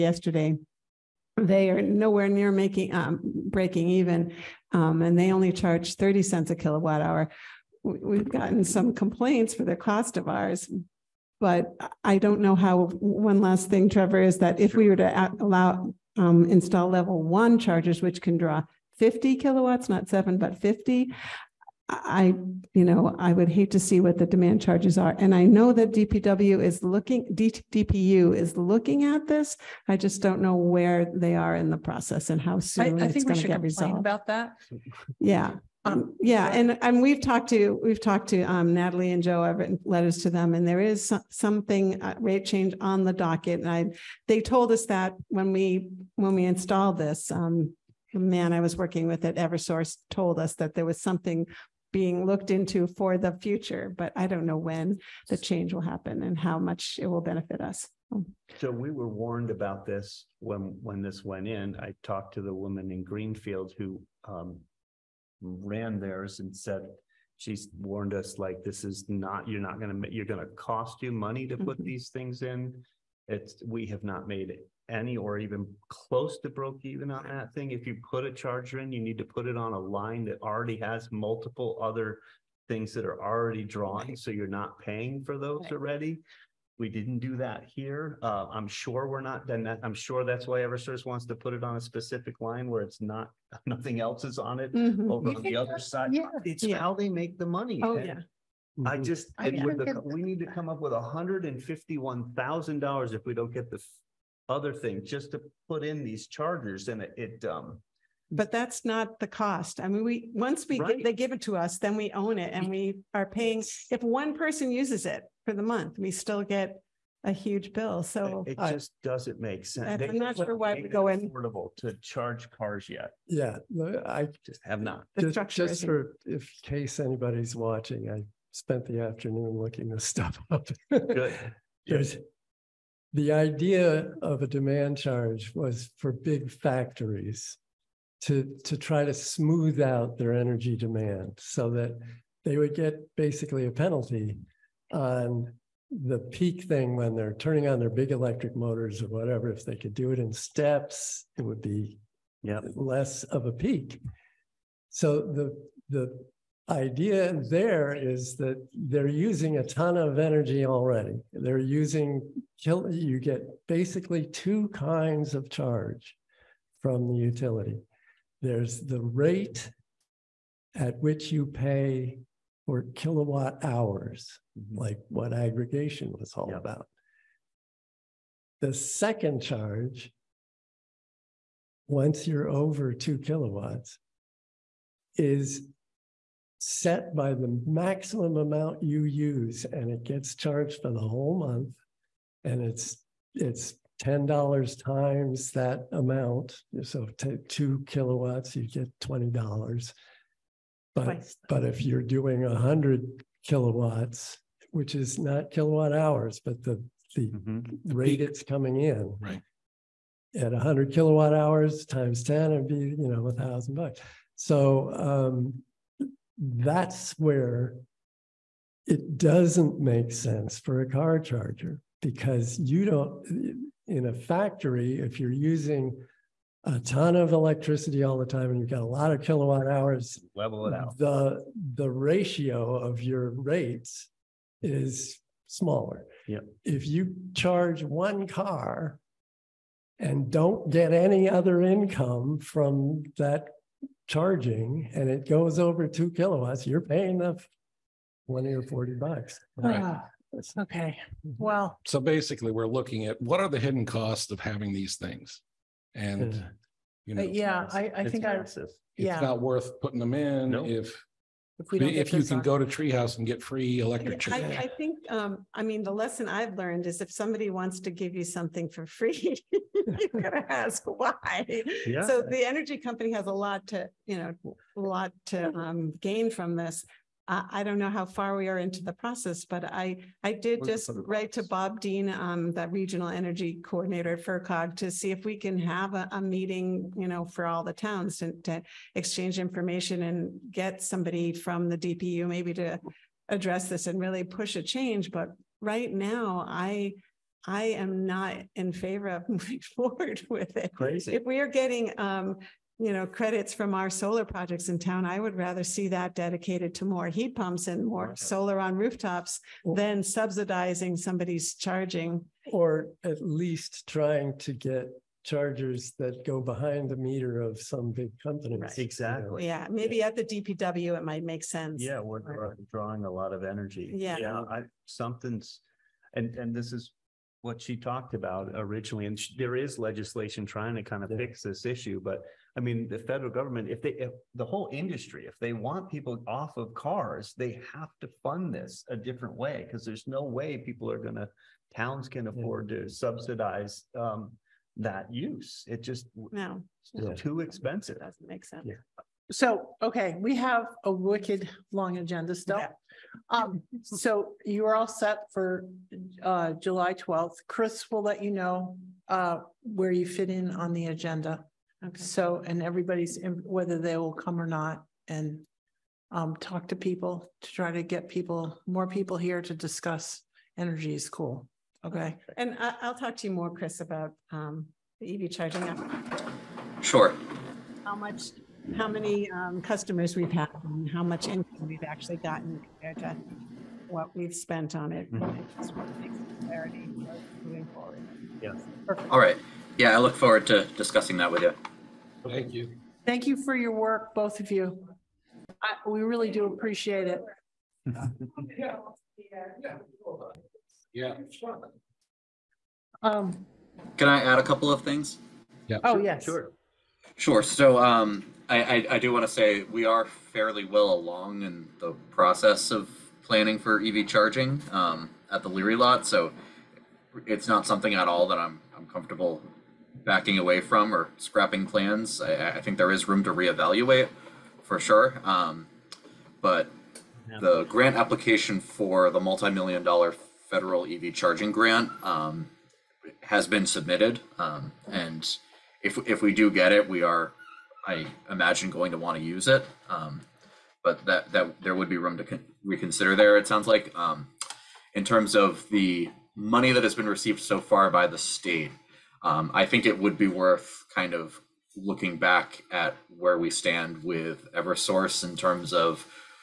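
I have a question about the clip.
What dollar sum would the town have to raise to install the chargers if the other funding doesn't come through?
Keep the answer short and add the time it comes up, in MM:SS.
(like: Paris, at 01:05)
$151,000, at 01:40.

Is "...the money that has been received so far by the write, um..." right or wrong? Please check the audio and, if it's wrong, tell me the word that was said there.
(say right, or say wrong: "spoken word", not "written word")
wrong: "state", not "write".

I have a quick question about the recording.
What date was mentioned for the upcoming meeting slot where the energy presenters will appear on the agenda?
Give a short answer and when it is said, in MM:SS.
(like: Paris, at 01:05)
July 12th, at 05:56.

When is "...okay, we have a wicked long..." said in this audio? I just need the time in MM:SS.
05:49.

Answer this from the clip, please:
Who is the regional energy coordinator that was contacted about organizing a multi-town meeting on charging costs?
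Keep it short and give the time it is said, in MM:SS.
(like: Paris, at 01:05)
Bob Dean, at 04:41.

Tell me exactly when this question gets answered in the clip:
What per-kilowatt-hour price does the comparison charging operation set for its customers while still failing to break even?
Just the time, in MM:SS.
00:05.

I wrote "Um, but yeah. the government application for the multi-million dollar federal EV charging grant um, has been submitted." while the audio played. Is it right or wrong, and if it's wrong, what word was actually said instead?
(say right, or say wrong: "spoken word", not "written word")
wrong: "grant", not "government".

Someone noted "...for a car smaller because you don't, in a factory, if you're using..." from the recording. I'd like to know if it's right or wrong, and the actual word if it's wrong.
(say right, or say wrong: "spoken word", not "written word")
wrong: "charger", not "smaller".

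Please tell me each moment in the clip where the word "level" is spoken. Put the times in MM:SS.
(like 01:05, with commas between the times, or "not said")
00:16, 03:50.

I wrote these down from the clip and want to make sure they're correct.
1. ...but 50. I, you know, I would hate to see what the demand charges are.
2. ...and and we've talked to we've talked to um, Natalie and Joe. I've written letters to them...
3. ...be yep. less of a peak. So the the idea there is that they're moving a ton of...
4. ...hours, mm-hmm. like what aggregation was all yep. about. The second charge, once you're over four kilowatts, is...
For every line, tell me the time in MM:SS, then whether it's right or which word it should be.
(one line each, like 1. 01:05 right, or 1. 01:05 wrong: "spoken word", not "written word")
1. 00:20 right
2. 00:36 right
3. 02:31 wrong: "using", not "moving"
4. 02:53 wrong: "two", not "four".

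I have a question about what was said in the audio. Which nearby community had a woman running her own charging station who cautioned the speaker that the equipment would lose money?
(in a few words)
Greenfield.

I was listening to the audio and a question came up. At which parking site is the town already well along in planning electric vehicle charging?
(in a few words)
Leary lot.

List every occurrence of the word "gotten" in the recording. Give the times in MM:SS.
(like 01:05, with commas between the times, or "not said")
00:08, 06:22.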